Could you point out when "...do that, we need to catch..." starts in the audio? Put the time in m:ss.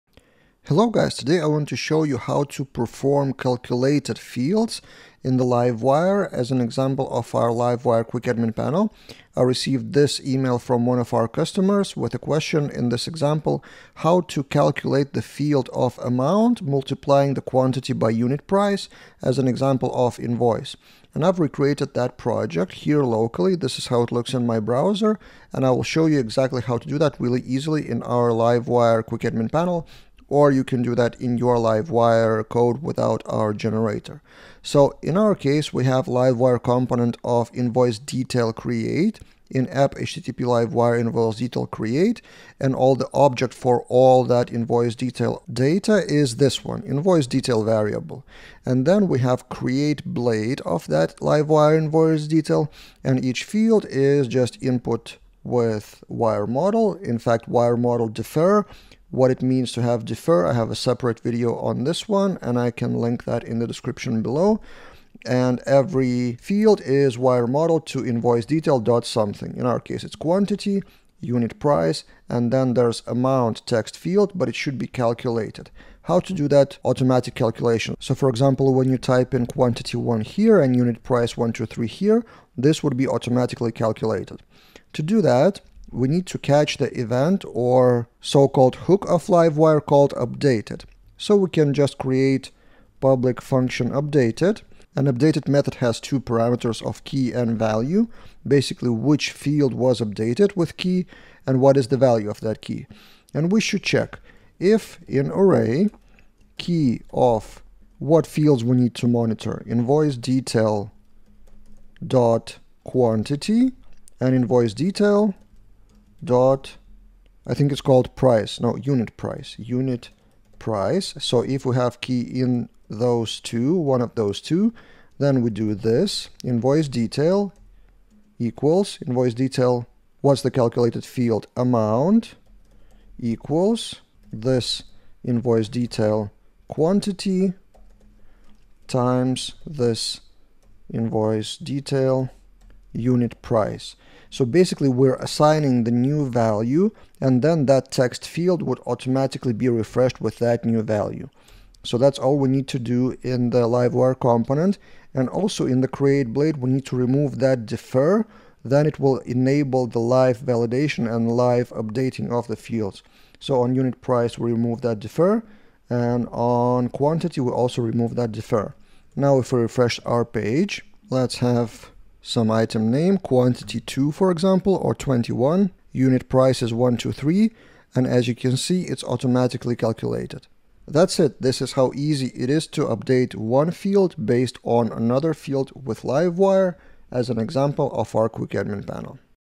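1:25.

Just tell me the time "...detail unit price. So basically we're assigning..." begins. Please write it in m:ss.
2:21.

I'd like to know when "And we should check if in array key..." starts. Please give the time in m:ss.
1:43.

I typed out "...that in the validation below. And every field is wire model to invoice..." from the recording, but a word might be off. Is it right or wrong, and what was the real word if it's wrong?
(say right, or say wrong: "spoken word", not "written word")
wrong: "description", not "validation".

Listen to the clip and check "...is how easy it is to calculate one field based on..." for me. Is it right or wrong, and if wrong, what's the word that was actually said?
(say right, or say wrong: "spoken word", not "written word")
wrong: "update", not "calculate".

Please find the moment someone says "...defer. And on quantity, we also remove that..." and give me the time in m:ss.
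2:44.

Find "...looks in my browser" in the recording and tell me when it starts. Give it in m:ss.
0:24.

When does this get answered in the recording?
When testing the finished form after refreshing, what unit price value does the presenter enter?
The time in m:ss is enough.
2:55.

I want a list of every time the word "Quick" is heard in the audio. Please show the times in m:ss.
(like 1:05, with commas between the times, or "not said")
0:08, 0:29, 3:08.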